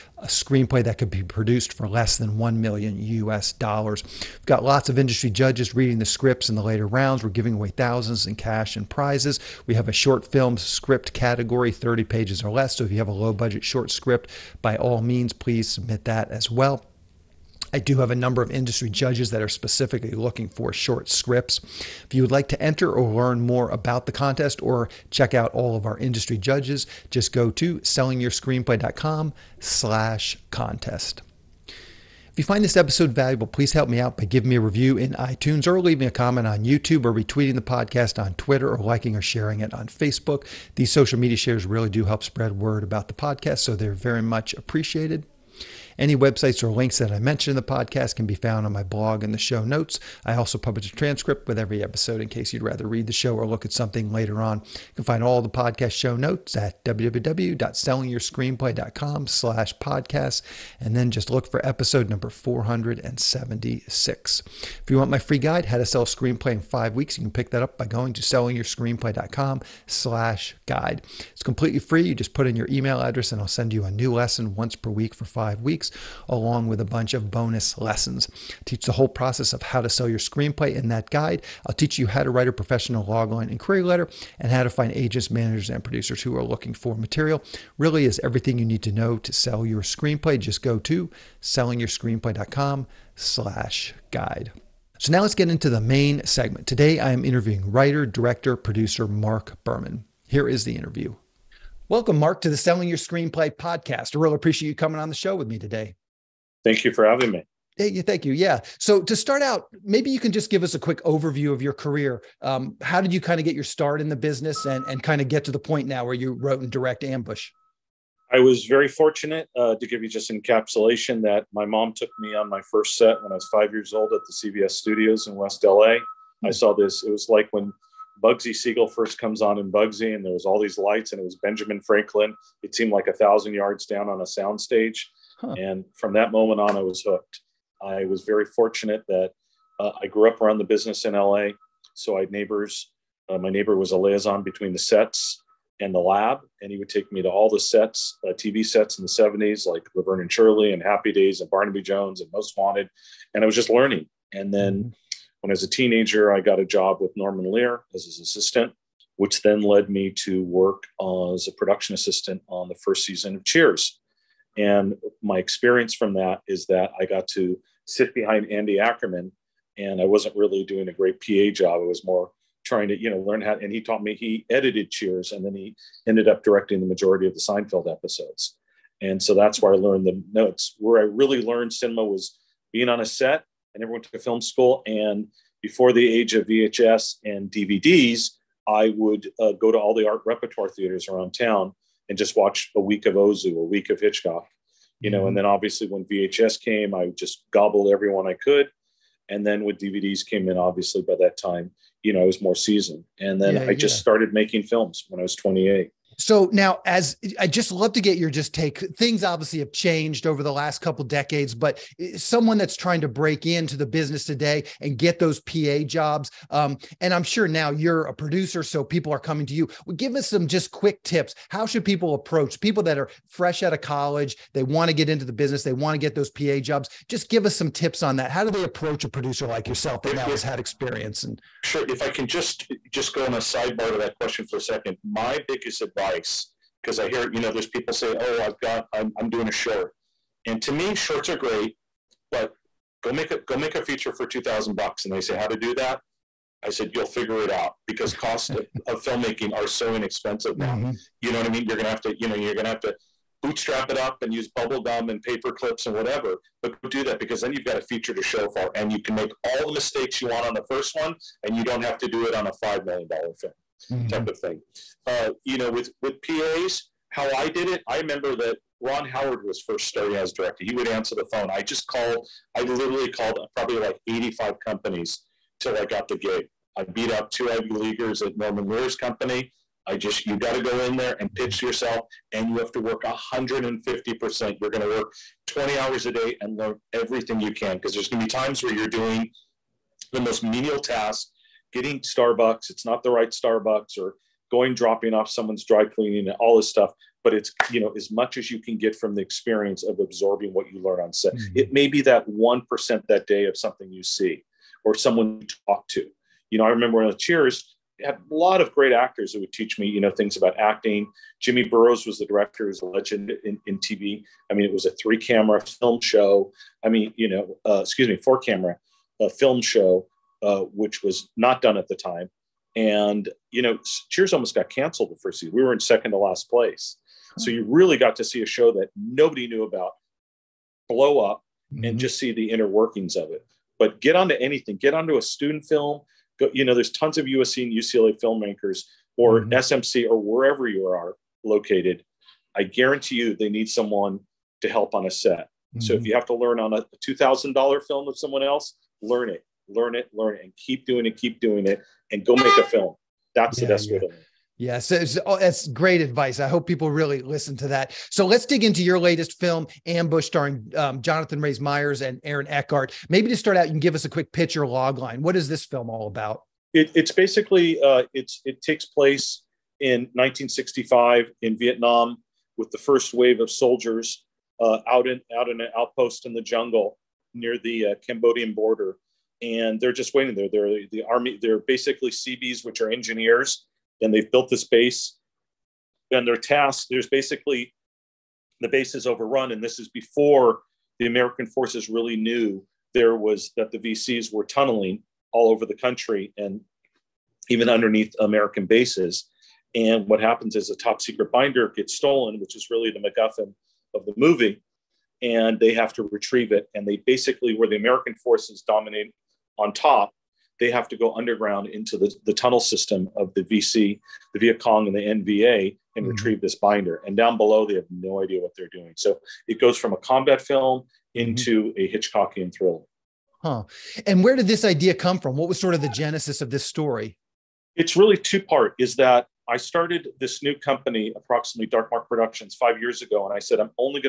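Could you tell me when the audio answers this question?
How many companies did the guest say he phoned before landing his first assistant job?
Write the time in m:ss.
4:34.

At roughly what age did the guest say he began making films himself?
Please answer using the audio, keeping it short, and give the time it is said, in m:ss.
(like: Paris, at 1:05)
28, at 3:25.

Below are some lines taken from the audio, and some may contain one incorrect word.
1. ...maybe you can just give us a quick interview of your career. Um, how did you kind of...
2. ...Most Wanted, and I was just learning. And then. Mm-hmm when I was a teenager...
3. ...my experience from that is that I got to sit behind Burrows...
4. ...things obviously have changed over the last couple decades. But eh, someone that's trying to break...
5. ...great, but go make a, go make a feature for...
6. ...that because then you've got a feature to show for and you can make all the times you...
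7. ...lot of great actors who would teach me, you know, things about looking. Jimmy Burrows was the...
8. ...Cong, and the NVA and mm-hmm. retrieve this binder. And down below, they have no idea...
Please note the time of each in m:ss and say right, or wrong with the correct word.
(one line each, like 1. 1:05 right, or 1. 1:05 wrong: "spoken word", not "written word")
1. 1:49 wrong: "overview", not "interview"
2. 2:32 right
3. 2:45 wrong: "Andy", not "Burrows"
4. 3:28 right
5. 4:01 right
6. 4:17 wrong: "mistakes", not "times"
7. 5:08 wrong: "acting", not "looking"
8. 6:54 right.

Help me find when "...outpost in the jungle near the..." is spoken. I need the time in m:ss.
6:15.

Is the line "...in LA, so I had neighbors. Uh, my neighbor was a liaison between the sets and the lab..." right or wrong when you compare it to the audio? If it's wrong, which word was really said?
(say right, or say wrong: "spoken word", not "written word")
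right.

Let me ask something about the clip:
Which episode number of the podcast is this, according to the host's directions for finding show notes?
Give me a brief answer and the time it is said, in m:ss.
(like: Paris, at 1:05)
476, at 1:02.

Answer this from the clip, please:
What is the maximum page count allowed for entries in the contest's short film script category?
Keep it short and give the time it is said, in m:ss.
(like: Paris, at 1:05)
30, at 0:11.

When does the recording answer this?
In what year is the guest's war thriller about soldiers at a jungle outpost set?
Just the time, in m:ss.
6:10.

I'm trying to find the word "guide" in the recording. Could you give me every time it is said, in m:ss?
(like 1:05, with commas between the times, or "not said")
1:05, 1:10, 1:21, 1:34.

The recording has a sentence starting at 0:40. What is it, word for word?
These social media shares really do help spread word about the podcast, so they're very much appreciated.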